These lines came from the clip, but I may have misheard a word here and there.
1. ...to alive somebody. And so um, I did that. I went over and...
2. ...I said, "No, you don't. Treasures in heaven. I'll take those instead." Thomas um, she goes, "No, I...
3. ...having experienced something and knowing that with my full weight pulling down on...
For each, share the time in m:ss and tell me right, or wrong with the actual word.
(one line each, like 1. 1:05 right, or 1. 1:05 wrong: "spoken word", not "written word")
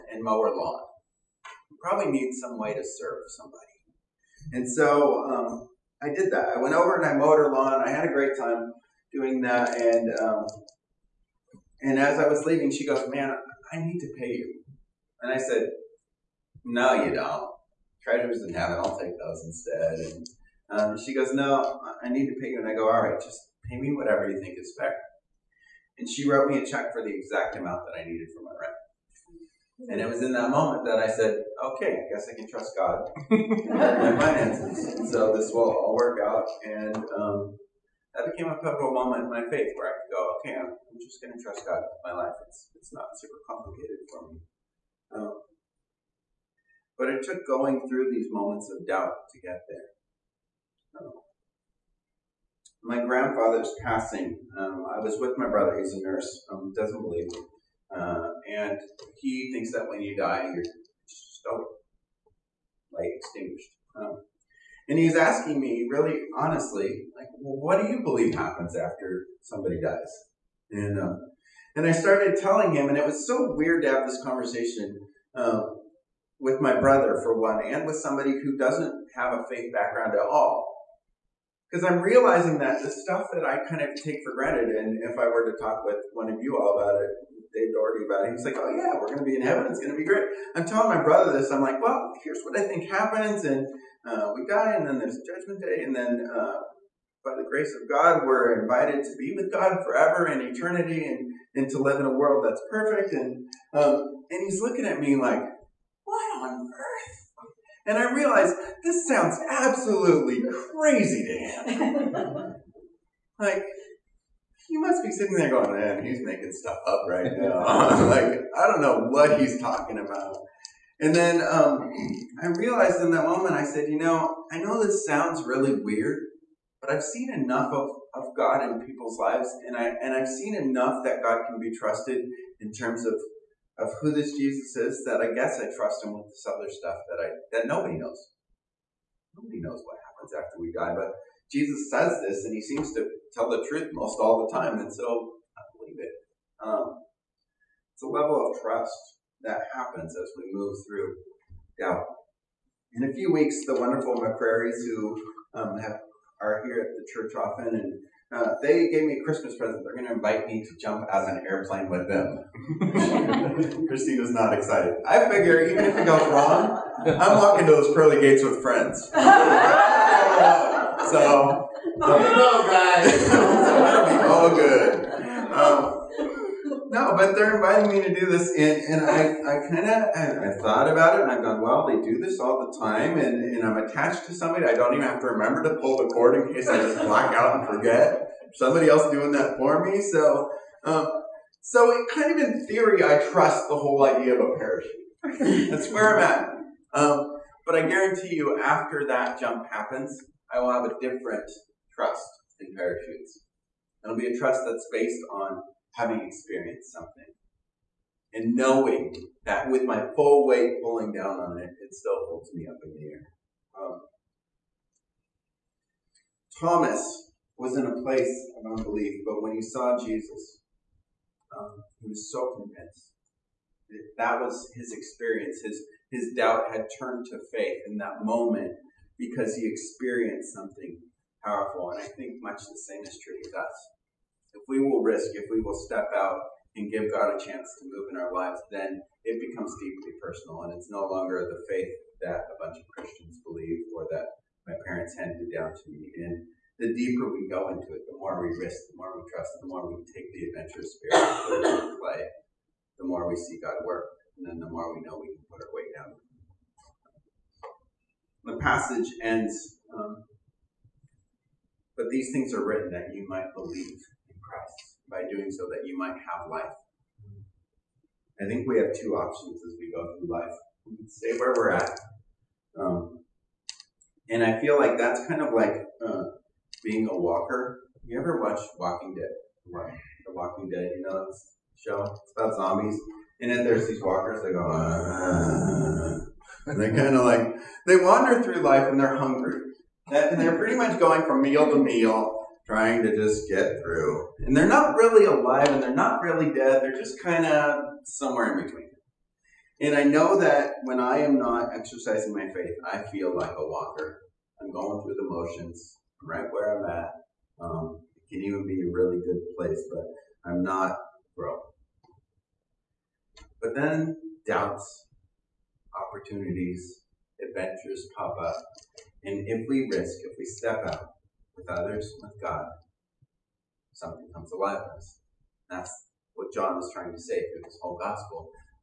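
1. 0:02 wrong: "serve", not "alive"
2. 0:15 wrong: "And", not "Thomas"
3. 3:25 right.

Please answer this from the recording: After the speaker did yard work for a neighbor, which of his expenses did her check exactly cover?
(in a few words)
Rent.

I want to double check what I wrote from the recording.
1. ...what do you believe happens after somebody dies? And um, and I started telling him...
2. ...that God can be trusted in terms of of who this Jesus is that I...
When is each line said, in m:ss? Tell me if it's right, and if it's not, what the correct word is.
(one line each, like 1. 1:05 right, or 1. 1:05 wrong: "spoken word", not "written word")
1. 1:07 right
2. 2:11 right.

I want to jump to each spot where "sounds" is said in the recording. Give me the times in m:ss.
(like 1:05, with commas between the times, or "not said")
1:49, 2:05.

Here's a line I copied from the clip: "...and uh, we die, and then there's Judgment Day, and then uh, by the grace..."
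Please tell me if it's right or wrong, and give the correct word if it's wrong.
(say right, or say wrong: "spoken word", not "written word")
right.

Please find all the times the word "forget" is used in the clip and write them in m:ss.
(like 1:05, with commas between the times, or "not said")
3:07.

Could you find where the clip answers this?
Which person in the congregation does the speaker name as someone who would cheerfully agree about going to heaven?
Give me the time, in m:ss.
1:27.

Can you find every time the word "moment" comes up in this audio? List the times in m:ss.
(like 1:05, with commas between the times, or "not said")
0:30, 0:38, 0:48, 2:03, 3:48.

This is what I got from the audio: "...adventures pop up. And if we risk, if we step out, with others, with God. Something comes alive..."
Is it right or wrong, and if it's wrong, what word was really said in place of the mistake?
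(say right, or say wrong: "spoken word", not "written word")
right.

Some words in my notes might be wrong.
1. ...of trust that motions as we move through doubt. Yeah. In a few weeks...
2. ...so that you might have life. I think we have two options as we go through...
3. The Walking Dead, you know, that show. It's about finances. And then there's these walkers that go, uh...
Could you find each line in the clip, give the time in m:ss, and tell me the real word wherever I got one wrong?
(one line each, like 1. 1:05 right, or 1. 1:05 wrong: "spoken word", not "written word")
1. 2:28 wrong: "happens", not "motions"
2. 4:25 right
3. 4:39 wrong: "zombies", not "finances".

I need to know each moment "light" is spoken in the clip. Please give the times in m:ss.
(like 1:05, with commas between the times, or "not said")
not said.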